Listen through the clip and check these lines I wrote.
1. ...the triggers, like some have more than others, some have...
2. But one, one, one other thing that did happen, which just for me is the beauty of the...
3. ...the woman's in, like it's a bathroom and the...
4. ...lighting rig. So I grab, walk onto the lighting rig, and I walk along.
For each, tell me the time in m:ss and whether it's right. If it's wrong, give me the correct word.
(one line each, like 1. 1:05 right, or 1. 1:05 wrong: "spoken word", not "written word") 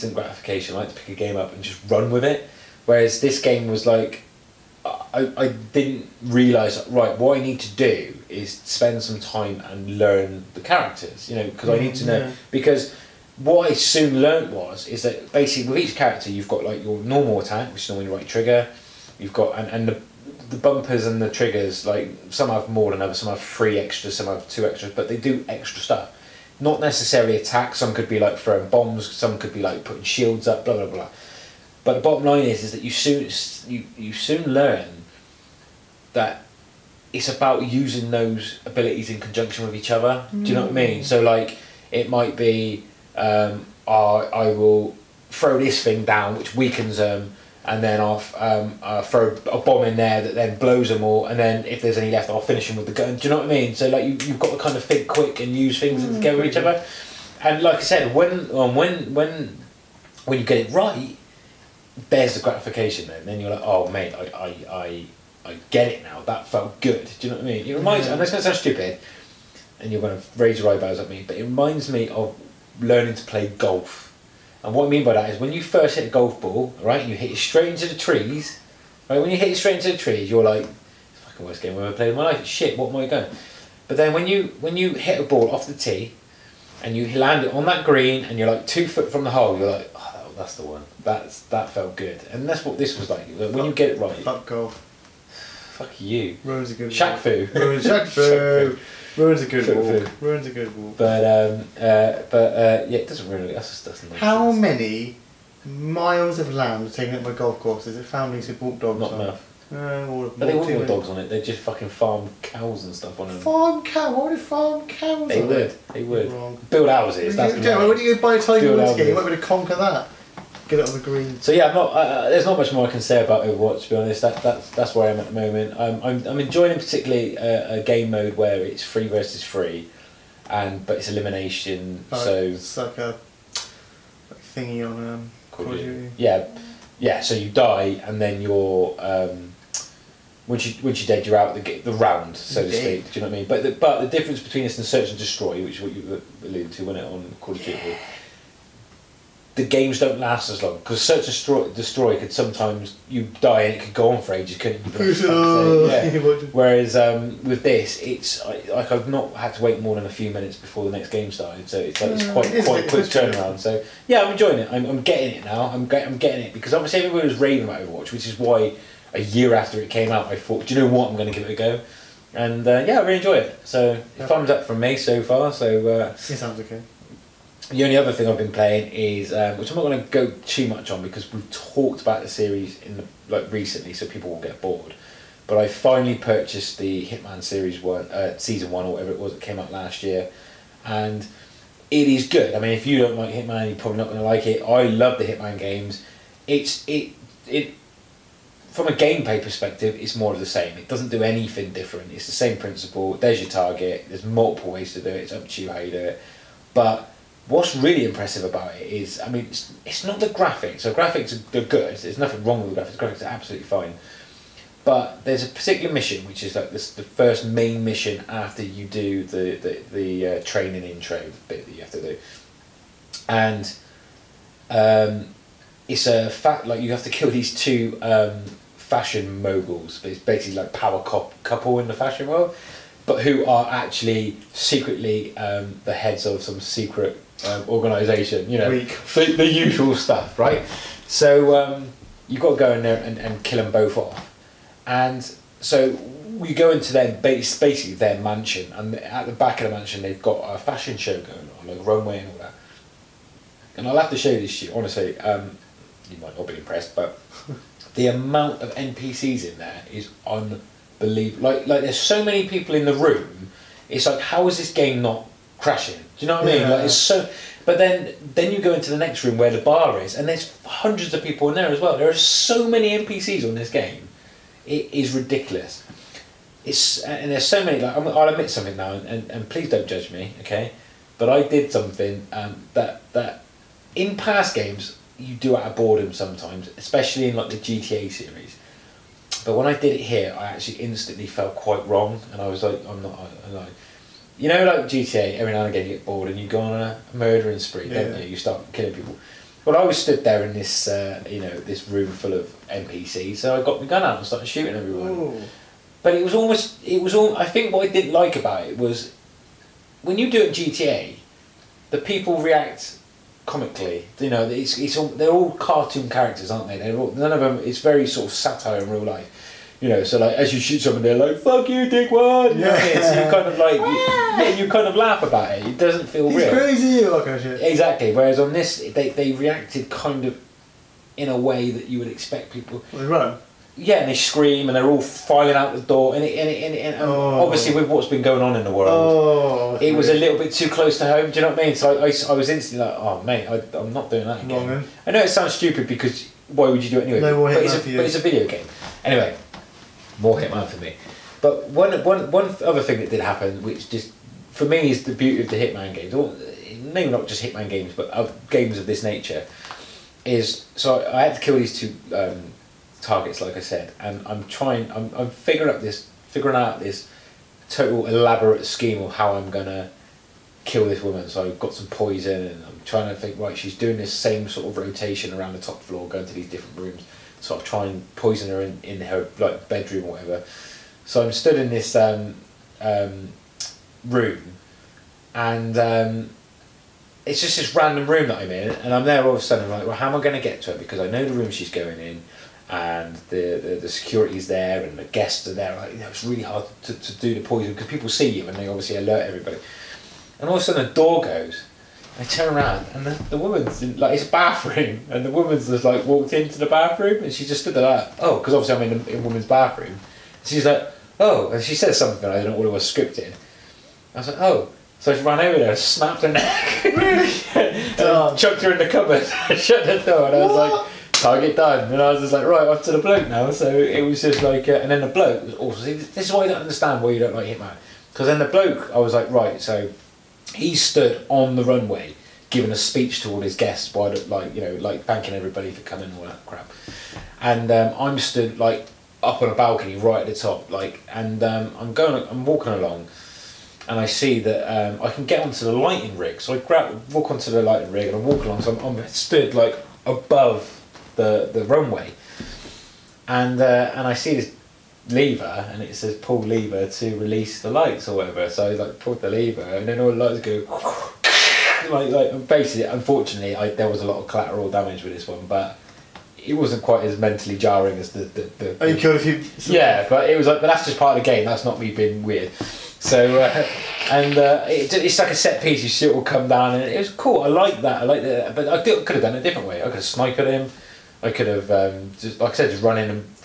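1. 0:21 right
2. 5:51 right
3. 6:43 right
4. 7:25 right.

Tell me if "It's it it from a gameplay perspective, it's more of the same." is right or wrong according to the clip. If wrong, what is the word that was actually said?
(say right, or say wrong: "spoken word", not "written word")
right.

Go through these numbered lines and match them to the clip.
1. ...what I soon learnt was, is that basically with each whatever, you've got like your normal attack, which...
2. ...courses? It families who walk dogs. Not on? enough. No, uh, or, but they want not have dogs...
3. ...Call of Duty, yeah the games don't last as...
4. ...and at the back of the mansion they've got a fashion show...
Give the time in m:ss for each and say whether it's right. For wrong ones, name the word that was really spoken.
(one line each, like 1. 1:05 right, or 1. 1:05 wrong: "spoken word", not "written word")
1. 0:13 wrong: "character", not "whatever"
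2. 1:47 right
3. 2:27 right
4. 4:08 right.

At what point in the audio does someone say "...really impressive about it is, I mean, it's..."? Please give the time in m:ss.
3:27.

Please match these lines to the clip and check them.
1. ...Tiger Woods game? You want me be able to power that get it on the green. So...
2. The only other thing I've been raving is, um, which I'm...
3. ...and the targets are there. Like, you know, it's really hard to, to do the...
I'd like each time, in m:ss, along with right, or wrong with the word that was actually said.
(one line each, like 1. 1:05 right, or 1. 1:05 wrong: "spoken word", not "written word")
1. 1:58 wrong: "conquer", not "power"
2. 2:57 wrong: "playing", not "raving"
3. 6:34 wrong: "guests", not "targets".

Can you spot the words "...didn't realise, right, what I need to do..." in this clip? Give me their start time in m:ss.
0:05.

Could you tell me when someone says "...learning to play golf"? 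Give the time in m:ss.
1:12.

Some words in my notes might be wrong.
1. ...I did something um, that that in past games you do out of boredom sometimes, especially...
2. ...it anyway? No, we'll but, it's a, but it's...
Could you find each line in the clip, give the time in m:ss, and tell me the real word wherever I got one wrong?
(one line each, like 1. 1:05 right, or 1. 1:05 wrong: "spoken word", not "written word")
1. 4:41 right
2. 5:46 right.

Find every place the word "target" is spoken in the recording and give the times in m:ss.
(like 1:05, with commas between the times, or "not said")
3:23, 6:02, 7:01.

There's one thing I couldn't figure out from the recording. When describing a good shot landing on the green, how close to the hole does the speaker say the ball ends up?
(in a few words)
2 foot.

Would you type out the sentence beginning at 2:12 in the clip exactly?
Oh, so it's like a like thingy on um, Call Yeah, yeah.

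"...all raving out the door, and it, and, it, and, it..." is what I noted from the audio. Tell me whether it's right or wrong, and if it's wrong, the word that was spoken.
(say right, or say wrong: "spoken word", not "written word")
wrong: "filing", not "raving".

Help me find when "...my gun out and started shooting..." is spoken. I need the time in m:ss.
5:03.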